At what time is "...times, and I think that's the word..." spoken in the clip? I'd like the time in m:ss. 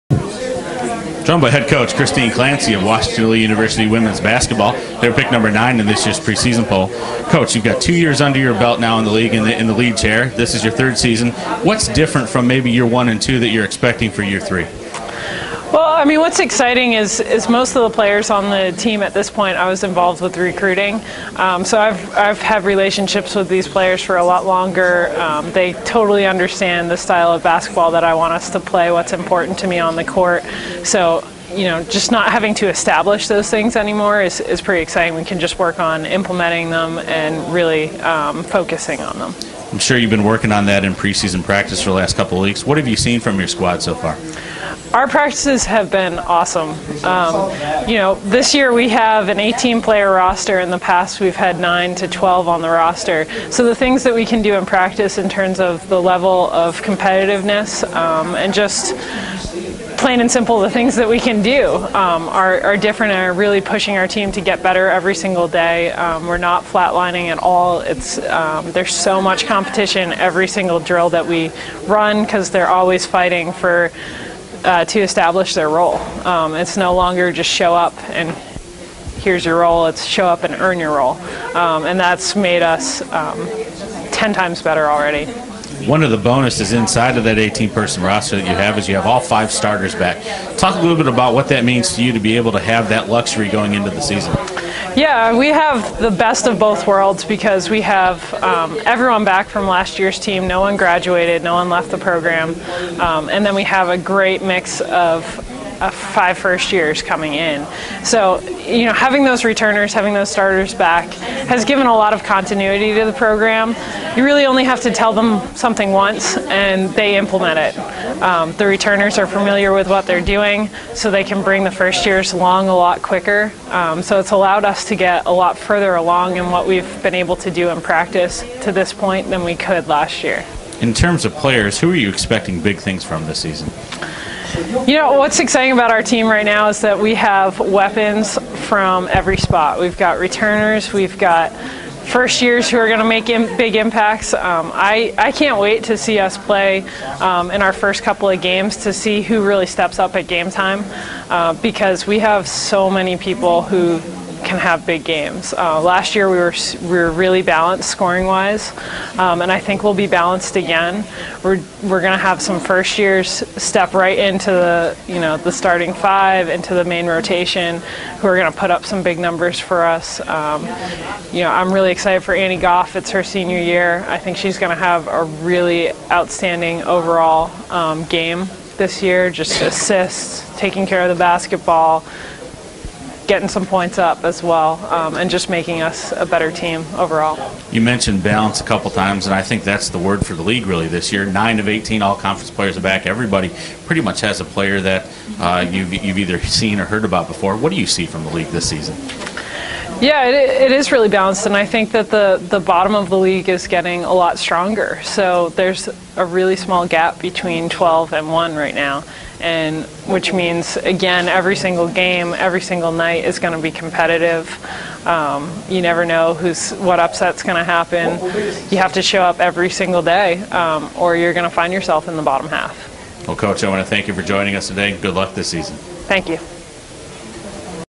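3:08.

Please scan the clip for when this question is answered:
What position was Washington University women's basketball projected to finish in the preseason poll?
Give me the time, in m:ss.
0:05.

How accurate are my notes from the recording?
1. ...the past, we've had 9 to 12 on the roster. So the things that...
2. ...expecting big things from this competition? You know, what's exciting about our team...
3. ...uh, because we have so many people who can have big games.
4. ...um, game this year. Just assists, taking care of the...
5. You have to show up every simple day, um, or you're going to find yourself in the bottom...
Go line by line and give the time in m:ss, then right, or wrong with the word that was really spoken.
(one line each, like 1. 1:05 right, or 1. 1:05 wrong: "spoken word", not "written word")
1. 0:50 right
2. 2:12 wrong: "season", not "competition"
3. 2:31 right
4. 2:57 right
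5. 3:38 wrong: "single", not "simple".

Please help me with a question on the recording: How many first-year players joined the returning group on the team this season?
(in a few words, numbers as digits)
5.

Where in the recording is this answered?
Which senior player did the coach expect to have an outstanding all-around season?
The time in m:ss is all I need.
2:52.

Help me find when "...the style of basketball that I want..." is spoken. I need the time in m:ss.
0:26.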